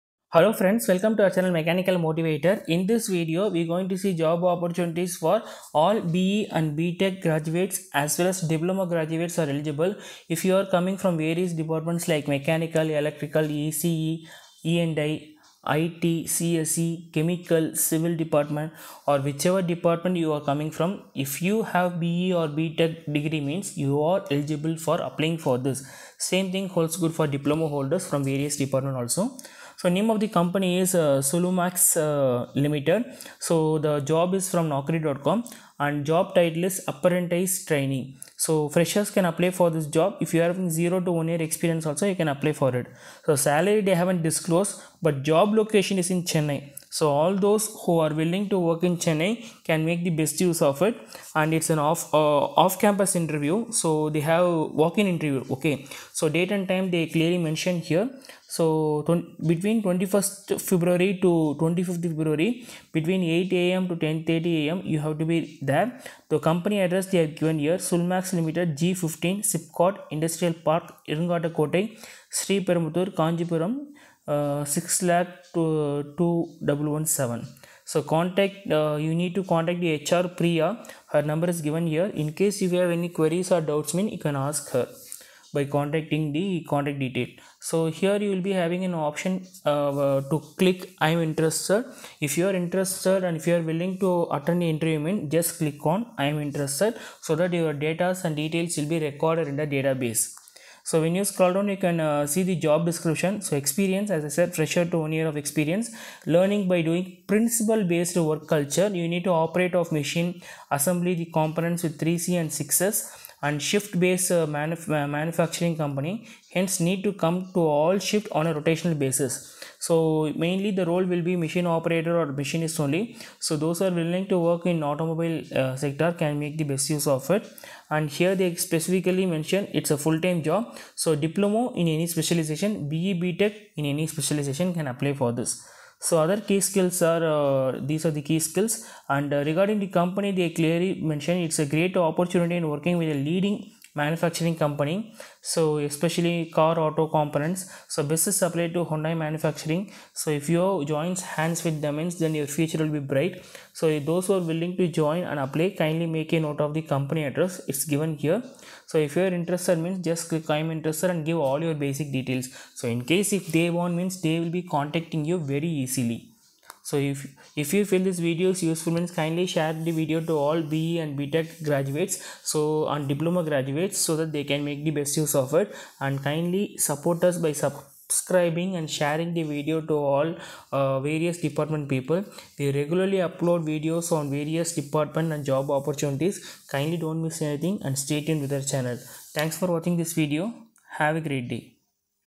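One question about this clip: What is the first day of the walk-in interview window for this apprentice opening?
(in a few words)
21st February.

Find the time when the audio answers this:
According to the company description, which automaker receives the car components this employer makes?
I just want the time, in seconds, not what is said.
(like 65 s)
148 s.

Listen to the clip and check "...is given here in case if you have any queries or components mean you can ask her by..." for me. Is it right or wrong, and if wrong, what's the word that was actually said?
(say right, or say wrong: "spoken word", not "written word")
wrong: "doubts", not "components".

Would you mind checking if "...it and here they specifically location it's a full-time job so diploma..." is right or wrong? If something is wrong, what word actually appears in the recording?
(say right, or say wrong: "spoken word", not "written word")
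wrong: "mention", not "location".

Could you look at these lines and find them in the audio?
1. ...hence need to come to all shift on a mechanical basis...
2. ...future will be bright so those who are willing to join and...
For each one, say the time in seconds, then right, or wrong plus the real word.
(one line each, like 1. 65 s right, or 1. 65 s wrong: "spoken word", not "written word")
1. 116 s wrong: "rotational", not "mechanical"
2. 152 s right.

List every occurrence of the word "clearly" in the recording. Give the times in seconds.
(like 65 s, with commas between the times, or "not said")
57 s, 140 s.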